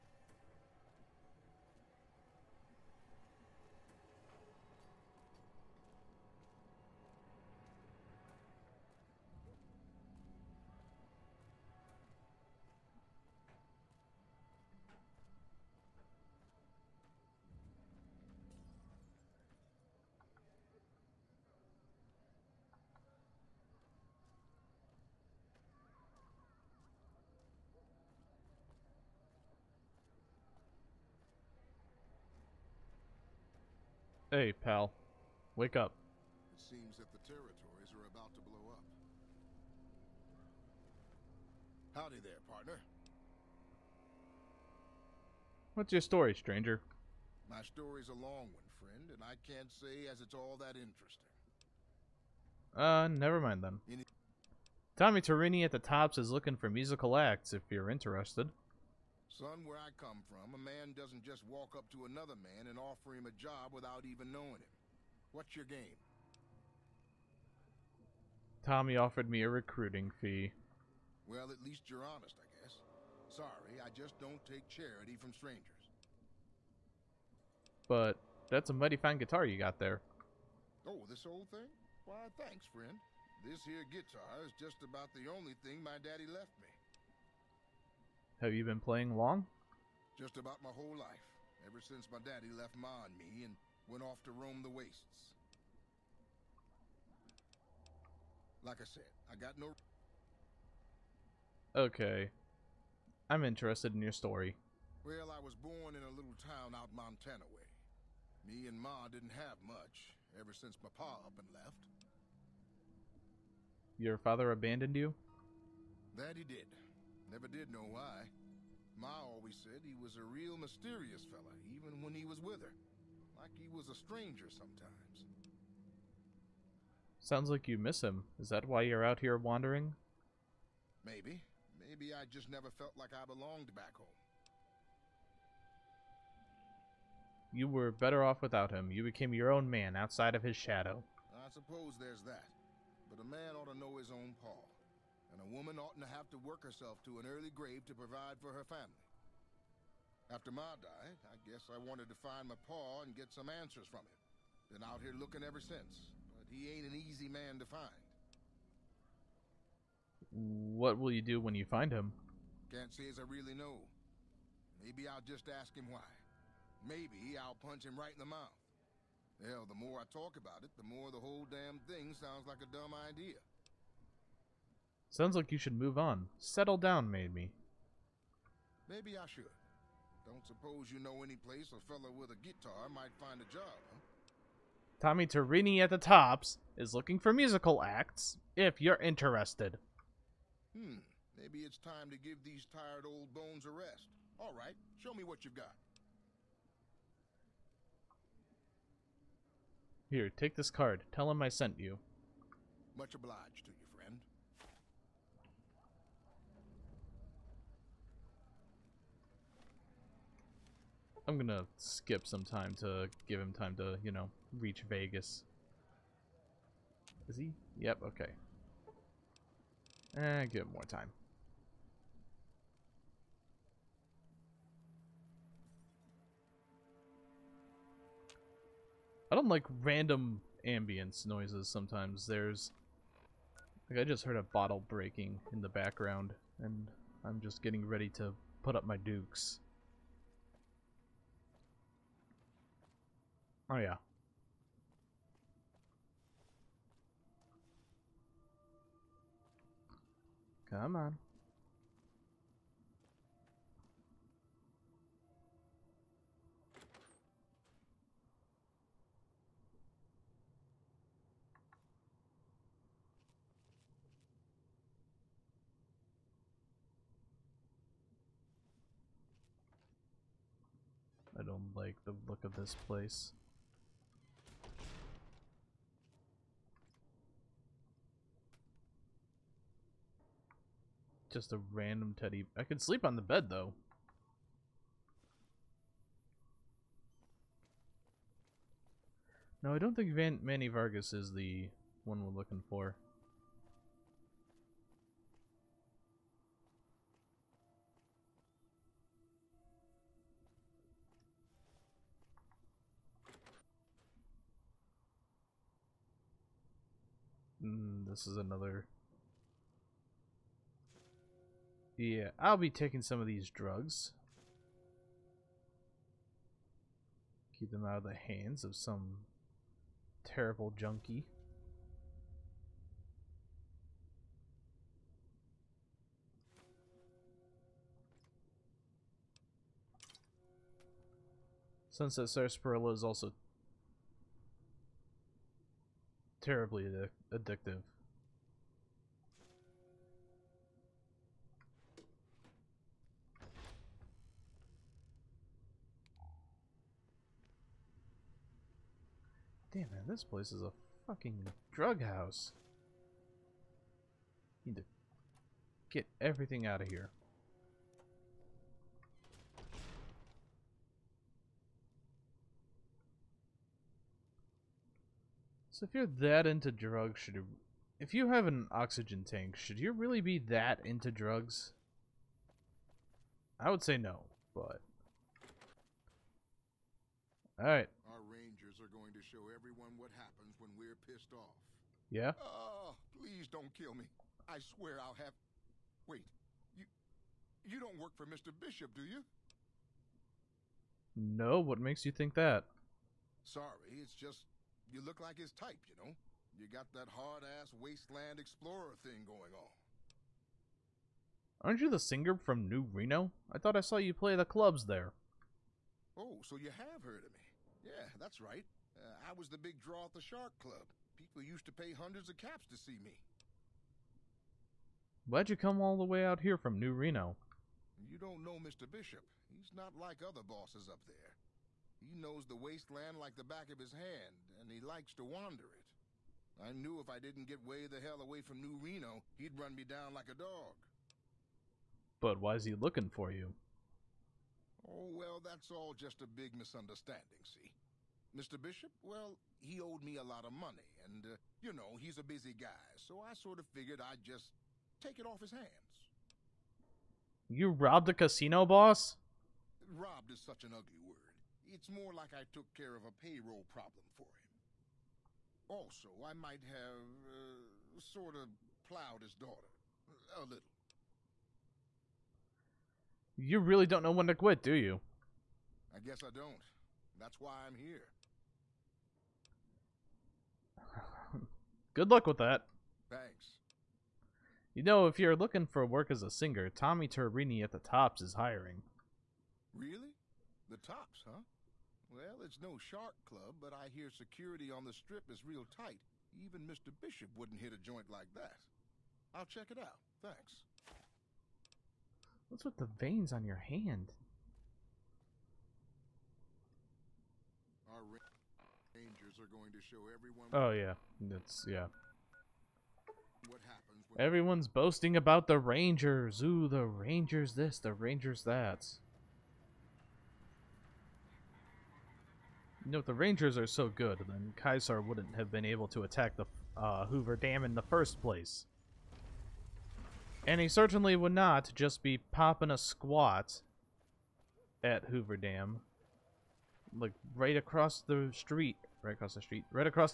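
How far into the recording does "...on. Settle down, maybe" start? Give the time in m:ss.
2:55.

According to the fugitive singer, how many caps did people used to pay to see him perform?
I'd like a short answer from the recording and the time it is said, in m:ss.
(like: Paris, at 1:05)
hundreds, at 6:51.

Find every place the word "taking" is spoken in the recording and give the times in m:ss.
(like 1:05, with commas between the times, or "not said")
5:12.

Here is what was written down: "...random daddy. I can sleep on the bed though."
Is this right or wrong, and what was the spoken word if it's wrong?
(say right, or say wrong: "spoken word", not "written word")
wrong: "teddy", not "daddy".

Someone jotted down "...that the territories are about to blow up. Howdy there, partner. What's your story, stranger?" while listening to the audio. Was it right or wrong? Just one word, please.
right.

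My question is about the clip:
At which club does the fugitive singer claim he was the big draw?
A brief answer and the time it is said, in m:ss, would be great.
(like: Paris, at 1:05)
the Shark Club, at 6:50.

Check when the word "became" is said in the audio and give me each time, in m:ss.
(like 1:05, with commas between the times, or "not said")
2:19.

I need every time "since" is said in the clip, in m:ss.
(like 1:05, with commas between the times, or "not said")
1:31, 1:50, 2:35.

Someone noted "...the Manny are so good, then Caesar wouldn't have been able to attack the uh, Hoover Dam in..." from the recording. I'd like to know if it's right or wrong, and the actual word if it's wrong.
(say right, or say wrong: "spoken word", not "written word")
wrong: "Rangers", not "Manny".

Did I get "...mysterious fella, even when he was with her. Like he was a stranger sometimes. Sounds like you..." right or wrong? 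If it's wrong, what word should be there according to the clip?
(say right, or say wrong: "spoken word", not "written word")
right.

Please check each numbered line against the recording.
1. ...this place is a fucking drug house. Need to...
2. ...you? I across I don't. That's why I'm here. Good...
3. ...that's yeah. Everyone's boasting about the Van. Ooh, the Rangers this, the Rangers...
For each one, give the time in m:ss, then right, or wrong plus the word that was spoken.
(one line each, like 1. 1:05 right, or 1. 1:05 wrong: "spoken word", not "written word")
1. 5:50 right
2. 7:44 wrong: "guess", not "across"
3. 8:21 wrong: "Rangers", not "Van".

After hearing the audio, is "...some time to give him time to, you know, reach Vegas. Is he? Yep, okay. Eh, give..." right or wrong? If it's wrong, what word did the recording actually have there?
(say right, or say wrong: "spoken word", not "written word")
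right.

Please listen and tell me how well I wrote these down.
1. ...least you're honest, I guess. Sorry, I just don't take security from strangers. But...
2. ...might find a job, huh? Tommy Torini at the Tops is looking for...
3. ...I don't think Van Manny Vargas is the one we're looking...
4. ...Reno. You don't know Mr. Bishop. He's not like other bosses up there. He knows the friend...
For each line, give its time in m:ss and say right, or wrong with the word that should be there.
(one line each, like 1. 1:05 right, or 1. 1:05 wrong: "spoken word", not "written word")
1. 1:11 wrong: "charity", not "security"
2. 3:02 right
3. 4:49 right
4. 6:56 wrong: "wasteland", not "friend".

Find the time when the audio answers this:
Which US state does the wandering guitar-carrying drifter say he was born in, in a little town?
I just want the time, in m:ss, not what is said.
1:46.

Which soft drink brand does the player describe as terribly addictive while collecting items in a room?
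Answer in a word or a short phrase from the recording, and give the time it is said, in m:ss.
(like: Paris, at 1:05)
Sunset Sarsaparilla, at 5:31.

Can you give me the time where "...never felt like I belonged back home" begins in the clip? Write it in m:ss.
2:12.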